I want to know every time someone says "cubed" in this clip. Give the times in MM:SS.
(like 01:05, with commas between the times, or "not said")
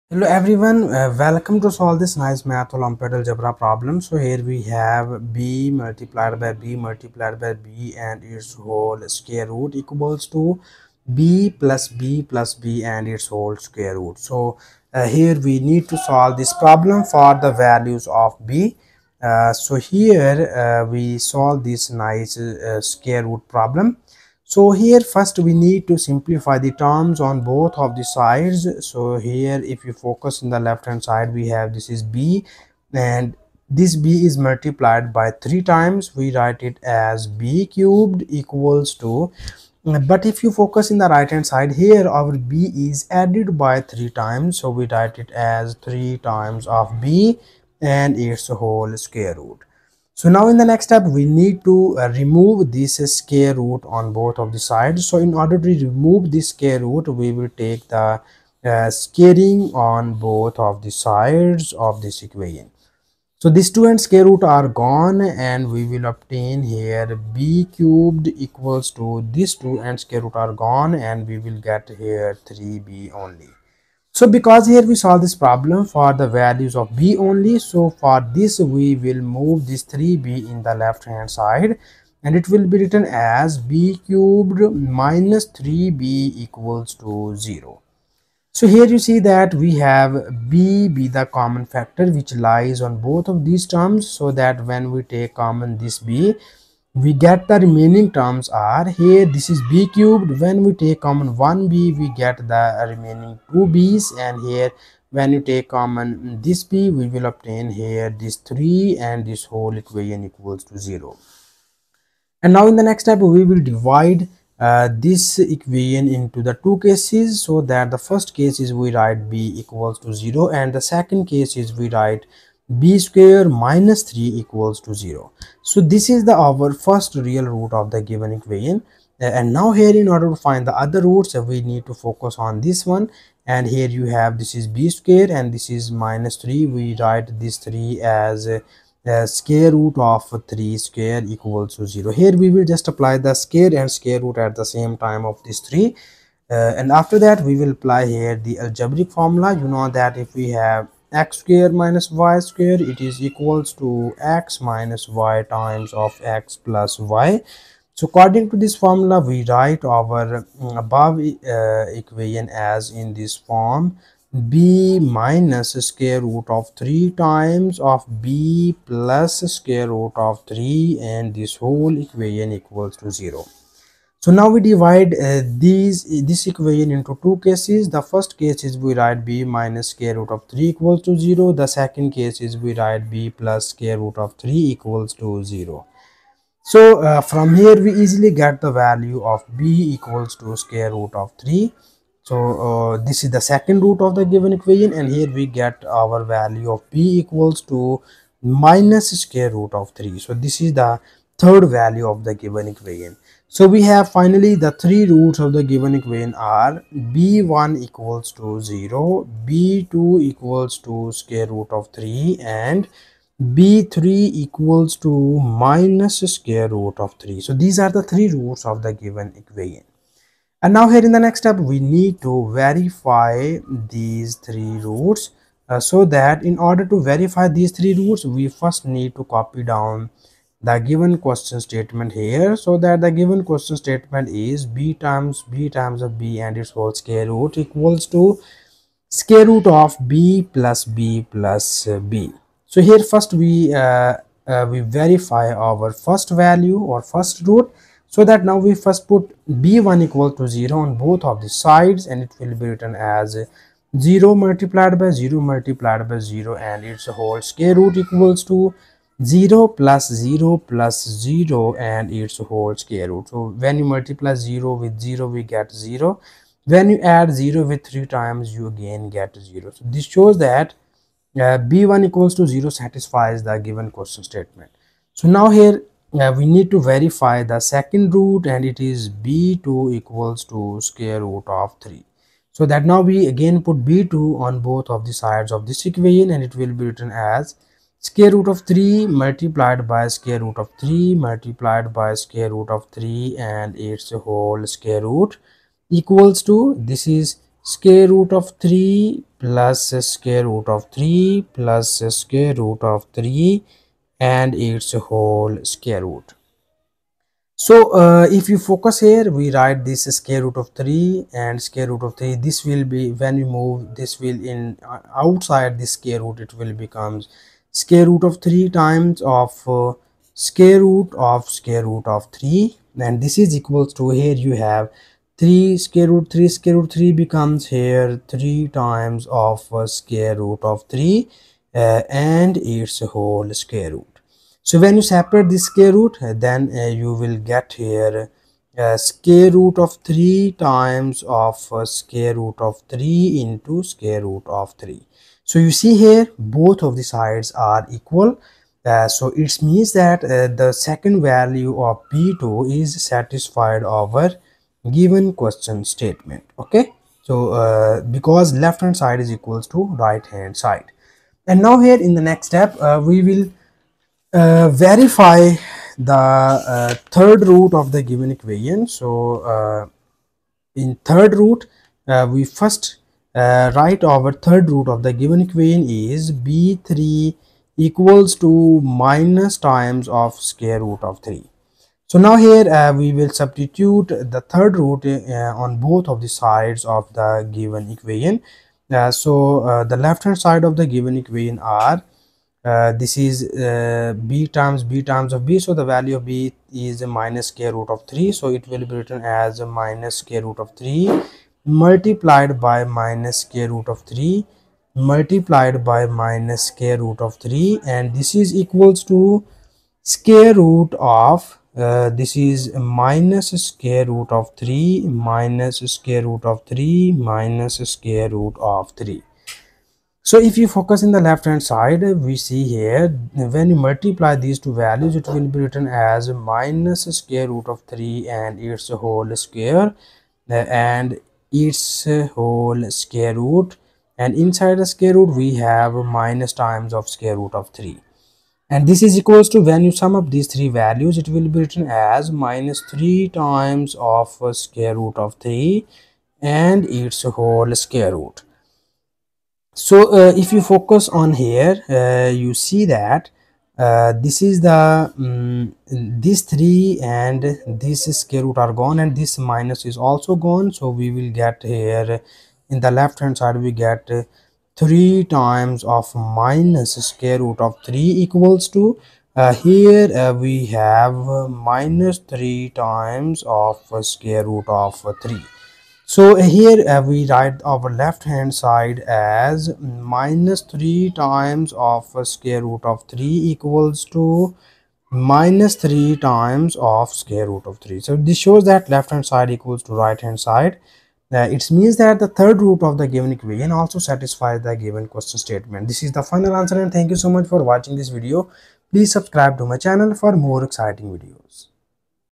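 00:37, 01:07, 01:24, 01:39.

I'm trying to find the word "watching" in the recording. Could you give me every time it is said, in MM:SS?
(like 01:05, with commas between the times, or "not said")
08:17.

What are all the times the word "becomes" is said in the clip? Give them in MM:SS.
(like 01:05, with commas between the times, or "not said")
05:16, 05:27.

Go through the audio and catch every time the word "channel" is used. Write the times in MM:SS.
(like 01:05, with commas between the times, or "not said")
08:19.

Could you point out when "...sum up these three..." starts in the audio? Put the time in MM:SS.
07:19.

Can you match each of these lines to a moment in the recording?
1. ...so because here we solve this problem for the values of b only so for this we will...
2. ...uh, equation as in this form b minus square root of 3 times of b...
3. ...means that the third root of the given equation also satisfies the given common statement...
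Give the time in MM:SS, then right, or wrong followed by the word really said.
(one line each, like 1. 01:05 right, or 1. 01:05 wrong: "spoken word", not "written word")
1. 01:14 right
2. 02:41 right
3. 08:11 wrong: "question", not "common".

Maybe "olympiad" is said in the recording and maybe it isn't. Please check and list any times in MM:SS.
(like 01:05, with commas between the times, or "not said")
00:02.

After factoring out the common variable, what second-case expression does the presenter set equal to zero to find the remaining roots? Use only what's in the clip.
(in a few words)
b^2 - 3.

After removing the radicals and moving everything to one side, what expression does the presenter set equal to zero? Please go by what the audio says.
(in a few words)
b^3 - 3b.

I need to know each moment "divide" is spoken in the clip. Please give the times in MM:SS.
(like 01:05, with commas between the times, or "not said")
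01:53, 02:54.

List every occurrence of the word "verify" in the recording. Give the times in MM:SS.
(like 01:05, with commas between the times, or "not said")
03:42, 03:47, 04:04, 04:36, 06:04.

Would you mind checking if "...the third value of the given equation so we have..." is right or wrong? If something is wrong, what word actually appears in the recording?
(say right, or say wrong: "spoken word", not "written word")
right.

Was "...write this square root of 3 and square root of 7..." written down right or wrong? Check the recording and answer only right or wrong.
wrong.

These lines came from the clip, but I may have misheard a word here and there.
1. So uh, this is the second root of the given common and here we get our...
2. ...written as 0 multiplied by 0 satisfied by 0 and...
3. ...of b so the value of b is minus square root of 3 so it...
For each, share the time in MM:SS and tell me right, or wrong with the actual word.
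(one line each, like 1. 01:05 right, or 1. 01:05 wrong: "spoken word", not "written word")
1. 03:12 wrong: "equation", not "common"
2. 04:12 wrong: "multiplied", not "satisfied"
3. 06:35 right.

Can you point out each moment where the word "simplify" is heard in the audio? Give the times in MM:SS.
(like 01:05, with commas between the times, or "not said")
00:26.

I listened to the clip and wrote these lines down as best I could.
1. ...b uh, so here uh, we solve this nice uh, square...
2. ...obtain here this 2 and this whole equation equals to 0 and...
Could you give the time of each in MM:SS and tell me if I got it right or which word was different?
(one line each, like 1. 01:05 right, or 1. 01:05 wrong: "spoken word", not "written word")
1. 00:18 right
2. 01:47 wrong: "3", not "2".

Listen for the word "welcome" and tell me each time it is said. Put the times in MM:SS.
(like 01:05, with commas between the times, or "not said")
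00:01.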